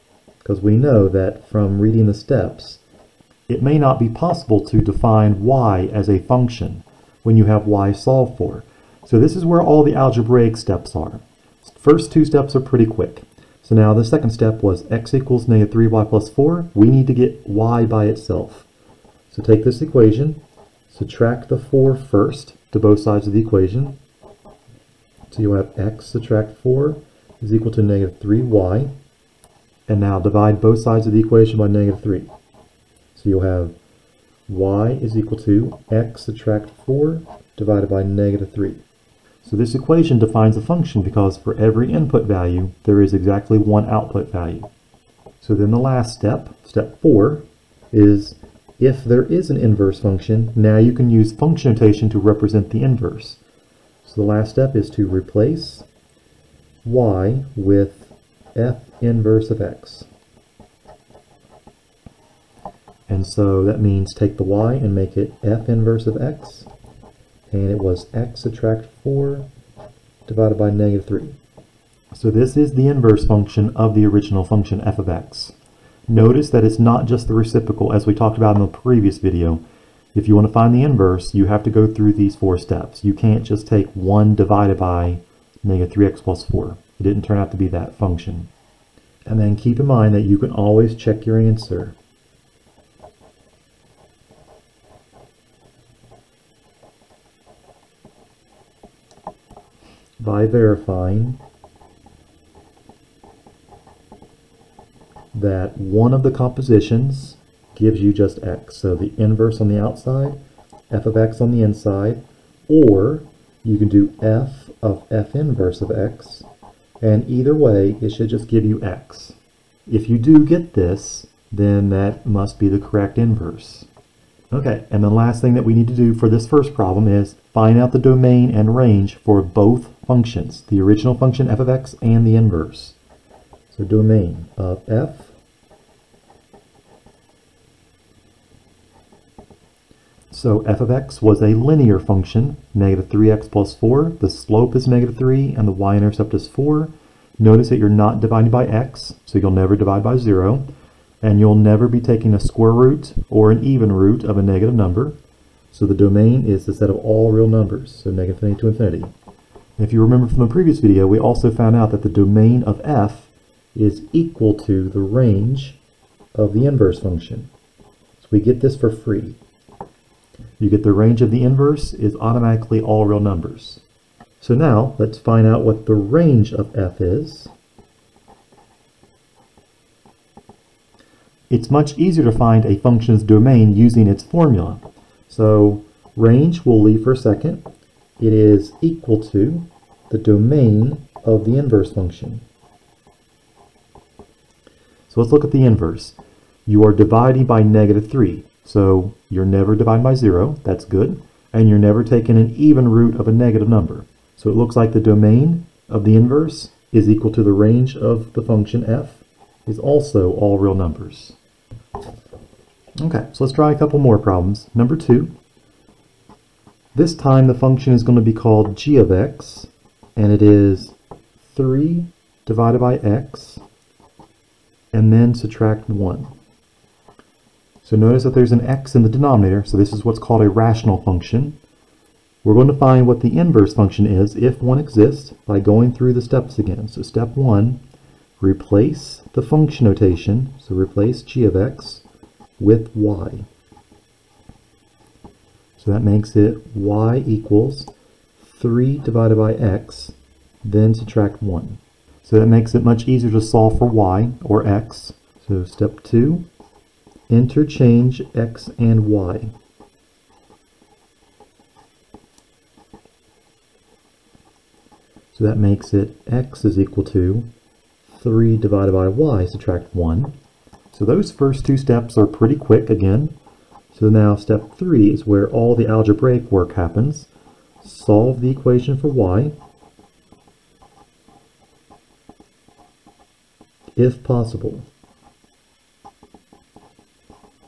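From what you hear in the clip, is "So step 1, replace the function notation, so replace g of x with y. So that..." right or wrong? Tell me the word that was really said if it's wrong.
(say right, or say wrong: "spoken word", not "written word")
right.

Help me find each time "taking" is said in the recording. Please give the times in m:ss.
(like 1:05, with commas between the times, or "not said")
2:31, 3:22.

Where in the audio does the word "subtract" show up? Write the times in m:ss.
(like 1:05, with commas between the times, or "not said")
0:20, 0:26, 0:36, 1:08, 3:45, 4:10, 4:29.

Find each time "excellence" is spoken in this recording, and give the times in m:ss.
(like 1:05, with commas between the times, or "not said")
not said.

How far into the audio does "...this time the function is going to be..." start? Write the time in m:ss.
3:36.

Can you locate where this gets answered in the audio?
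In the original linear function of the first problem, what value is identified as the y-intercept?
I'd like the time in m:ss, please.
2:25.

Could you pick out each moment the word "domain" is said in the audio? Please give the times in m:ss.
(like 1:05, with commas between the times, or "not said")
2:07, 2:13, 2:35, 2:42, 3:03, 3:10, 3:24.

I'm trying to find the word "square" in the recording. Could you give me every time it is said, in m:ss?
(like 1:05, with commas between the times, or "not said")
2:32.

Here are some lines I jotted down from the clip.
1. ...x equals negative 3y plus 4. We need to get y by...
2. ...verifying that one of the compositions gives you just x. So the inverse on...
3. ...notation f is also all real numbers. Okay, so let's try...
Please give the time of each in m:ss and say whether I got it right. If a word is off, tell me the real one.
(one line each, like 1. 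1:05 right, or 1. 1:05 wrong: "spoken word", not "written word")
1. 0:14 right
2. 1:40 right
3. 3:28 wrong: "function", not "notation".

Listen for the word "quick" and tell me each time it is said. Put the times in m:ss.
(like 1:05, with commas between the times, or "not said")
0:12, 4:32.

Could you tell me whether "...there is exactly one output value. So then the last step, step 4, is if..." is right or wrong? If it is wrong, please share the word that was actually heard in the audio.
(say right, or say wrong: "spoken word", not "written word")
right.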